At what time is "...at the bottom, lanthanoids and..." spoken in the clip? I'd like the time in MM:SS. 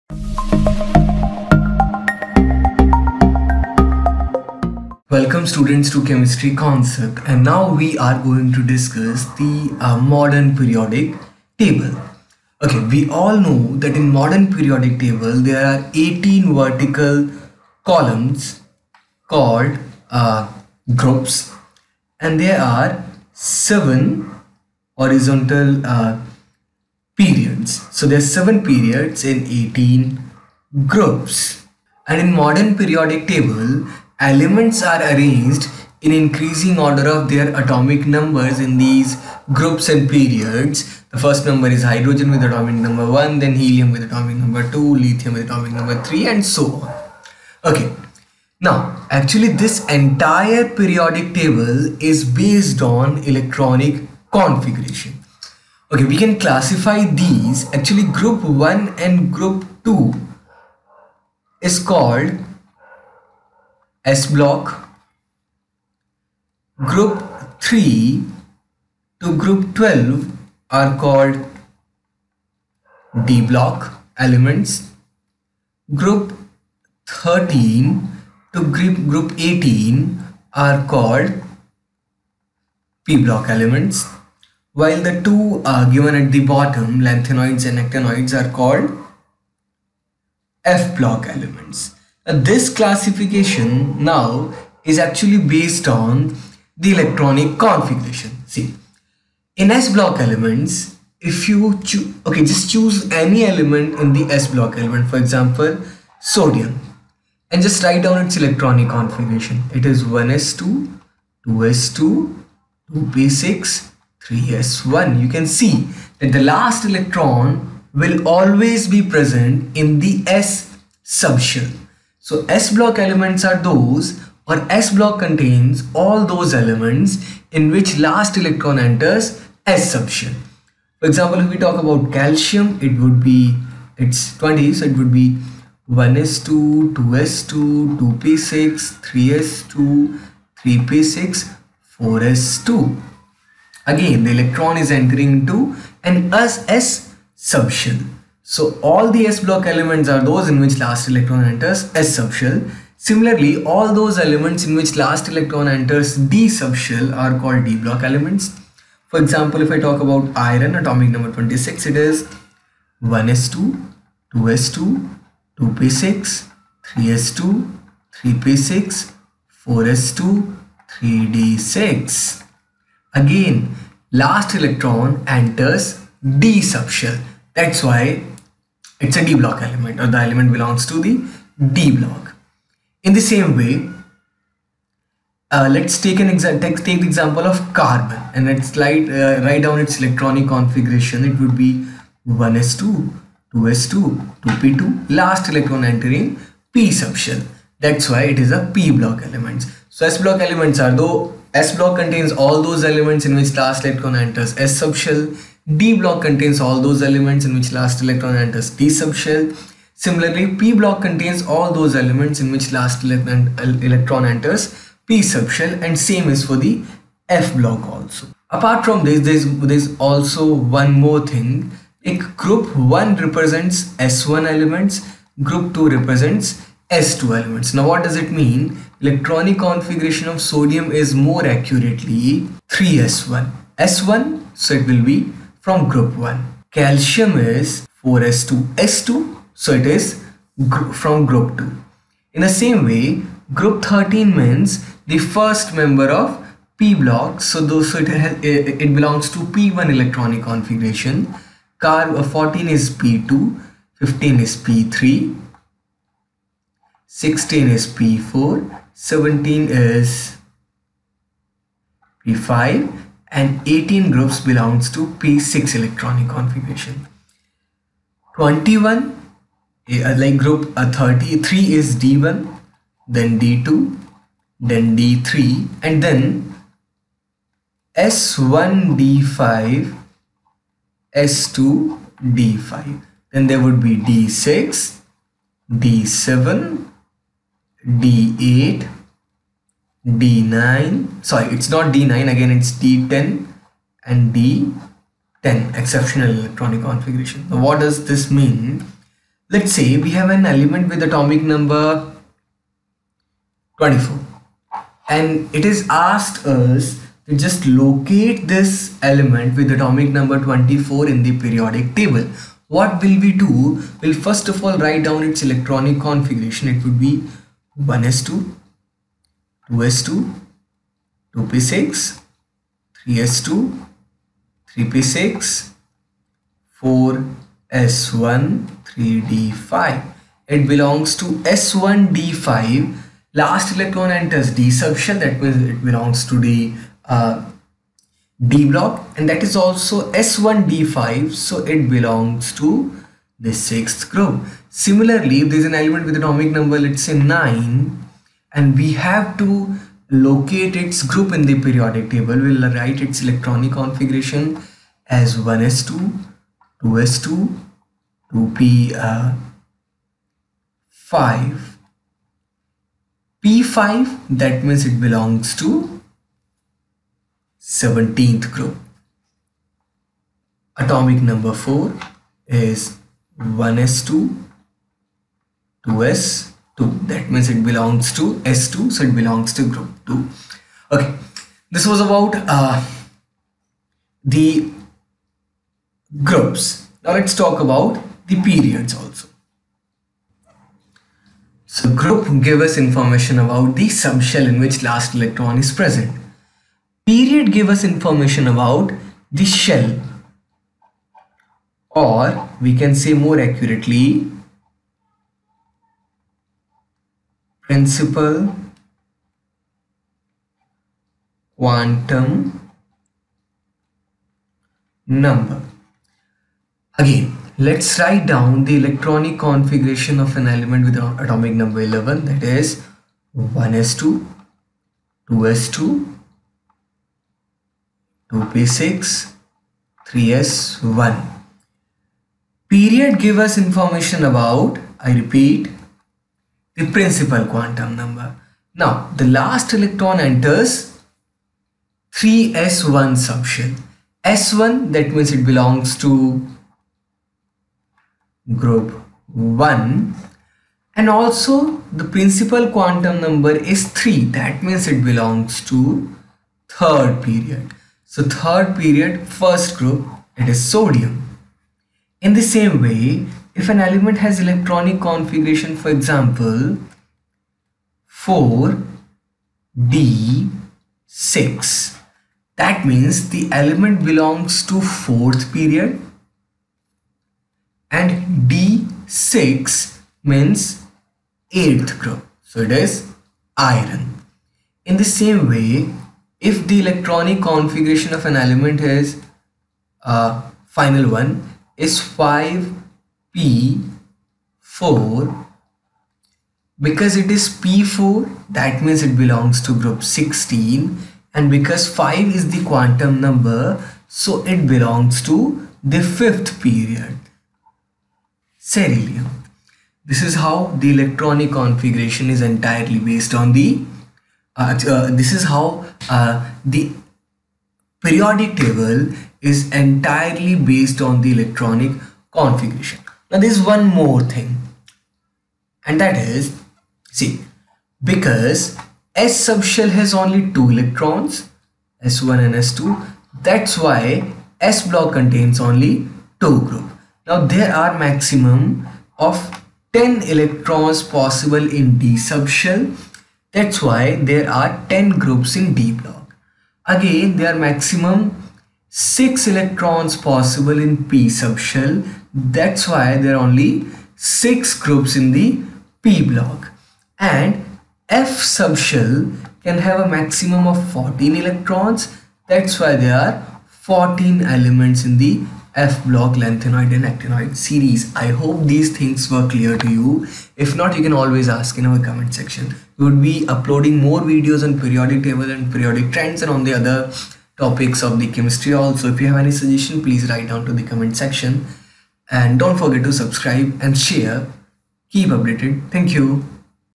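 01:26.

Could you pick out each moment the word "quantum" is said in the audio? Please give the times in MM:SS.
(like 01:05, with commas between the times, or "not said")
06:51, 07:17, 07:32, 08:22.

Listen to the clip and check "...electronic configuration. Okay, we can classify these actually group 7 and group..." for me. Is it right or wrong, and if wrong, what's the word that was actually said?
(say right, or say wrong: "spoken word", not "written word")
wrong: "1", not "7".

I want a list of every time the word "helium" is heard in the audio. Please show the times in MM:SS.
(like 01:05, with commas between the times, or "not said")
00:43.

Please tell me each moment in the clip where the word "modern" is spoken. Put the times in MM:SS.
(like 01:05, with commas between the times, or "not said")
00:09, 00:14, 00:32.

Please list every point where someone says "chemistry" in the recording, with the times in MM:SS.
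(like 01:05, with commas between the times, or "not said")
00:06, 09:38.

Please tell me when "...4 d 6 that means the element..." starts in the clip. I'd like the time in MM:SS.
07:48.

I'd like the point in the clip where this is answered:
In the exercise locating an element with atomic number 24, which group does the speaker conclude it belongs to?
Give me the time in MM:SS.
05:43.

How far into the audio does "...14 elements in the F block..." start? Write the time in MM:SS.
09:23.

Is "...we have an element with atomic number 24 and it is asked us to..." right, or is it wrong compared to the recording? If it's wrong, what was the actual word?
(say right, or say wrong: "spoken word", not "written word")
right.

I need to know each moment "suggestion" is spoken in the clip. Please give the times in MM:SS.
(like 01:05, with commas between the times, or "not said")
09:39.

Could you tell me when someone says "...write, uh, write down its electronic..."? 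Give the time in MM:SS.
03:08.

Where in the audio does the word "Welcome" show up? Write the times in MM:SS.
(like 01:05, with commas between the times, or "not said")
00:05.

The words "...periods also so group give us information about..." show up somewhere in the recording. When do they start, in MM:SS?
06:28.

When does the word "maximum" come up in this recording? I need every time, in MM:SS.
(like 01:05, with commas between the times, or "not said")
08:58, 09:07, 09:20.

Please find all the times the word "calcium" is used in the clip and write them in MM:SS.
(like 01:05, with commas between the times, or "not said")
02:12, 03:56.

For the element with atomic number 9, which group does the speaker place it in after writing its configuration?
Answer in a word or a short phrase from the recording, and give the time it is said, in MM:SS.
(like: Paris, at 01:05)
17th group, at 06:07.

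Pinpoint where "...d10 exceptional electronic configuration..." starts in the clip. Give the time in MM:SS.
04:54.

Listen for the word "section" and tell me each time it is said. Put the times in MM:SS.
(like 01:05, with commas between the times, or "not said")
09:32, 09:41.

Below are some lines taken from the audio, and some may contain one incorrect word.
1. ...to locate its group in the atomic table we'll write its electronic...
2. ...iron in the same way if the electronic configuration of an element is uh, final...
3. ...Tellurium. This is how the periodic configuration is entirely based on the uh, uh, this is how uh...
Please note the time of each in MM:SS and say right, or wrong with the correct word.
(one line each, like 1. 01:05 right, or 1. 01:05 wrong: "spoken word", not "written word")
1. 05:49 wrong: "periodic", not "atomic"
2. 08:03 right
3. 08:28 wrong: "electronic", not "periodic".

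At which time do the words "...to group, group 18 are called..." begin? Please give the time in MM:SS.
01:18.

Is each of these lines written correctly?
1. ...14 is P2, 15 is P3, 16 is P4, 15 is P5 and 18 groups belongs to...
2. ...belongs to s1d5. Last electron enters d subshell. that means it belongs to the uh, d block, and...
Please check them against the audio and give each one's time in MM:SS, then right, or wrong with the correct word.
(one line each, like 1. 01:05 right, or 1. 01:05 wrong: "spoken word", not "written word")
1. 04:12 wrong: "17", not "15"
2. 05:30 right.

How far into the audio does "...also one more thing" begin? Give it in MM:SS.
03:39.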